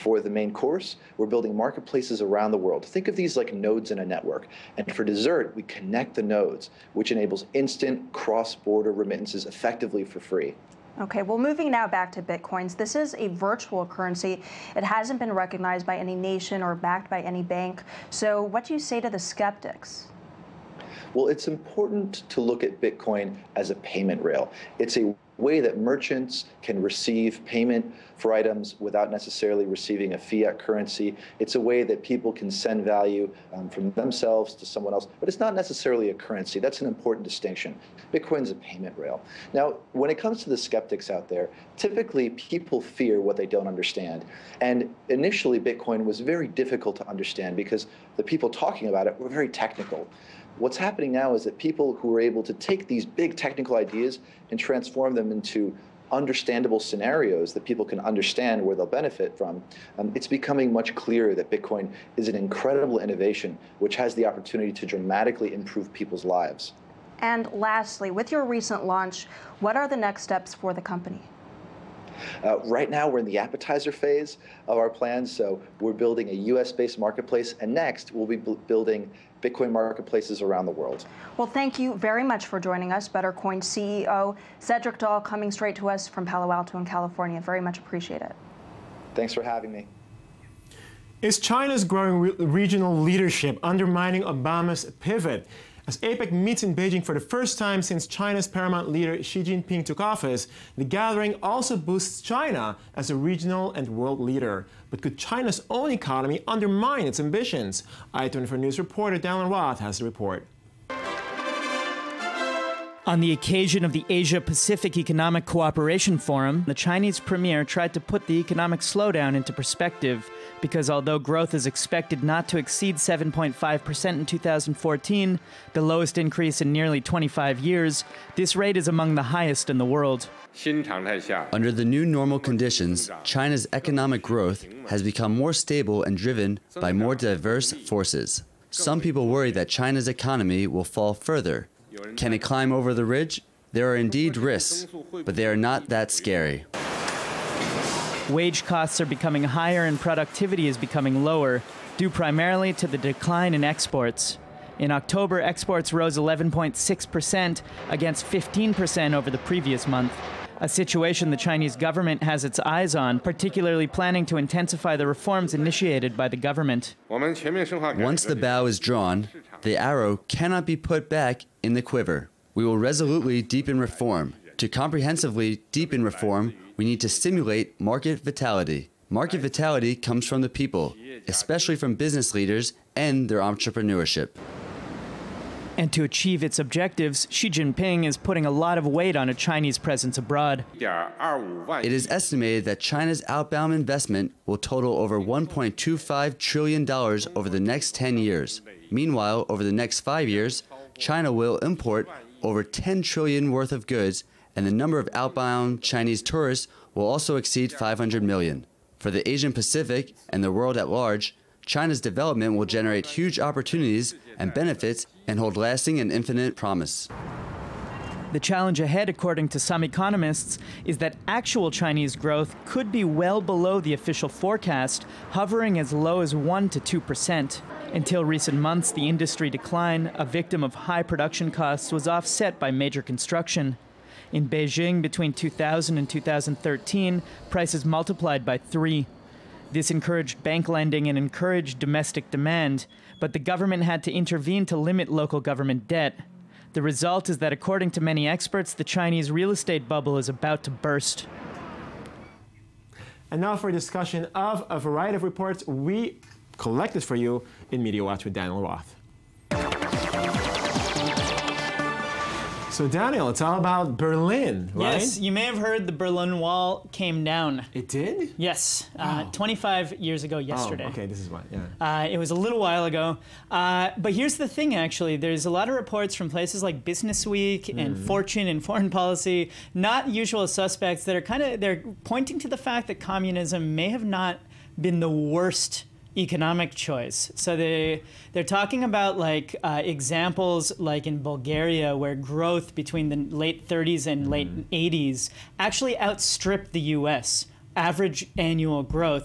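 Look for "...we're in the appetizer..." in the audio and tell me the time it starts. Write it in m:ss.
1:13.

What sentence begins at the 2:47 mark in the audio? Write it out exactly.
Once the bow is drawn, the arrow cannot be put back in the quiver.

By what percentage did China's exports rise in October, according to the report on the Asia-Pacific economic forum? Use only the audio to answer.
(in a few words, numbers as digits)
11.6%.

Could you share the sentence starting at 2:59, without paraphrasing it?
Market vitality comes from the people, especially from business leaders and their entrepreneurship.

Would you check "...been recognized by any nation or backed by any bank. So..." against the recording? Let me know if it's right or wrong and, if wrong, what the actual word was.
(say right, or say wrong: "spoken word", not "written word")
right.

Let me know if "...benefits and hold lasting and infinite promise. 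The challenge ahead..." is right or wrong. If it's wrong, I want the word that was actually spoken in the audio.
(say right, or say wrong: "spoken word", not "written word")
right.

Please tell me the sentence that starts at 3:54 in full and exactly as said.
In Beijing, between 2000 and 2013, prices multiplied by three.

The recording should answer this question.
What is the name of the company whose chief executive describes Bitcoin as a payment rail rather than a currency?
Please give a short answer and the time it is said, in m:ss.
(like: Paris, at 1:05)
Buttercoin, at 1:23.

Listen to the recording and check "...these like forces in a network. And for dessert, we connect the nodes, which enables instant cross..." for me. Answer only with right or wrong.
wrong.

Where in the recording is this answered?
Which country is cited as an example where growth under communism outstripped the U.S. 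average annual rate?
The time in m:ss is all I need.
4:51.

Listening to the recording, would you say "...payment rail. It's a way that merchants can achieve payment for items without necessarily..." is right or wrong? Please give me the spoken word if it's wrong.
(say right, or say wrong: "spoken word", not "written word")
wrong: "receive", not "achieve".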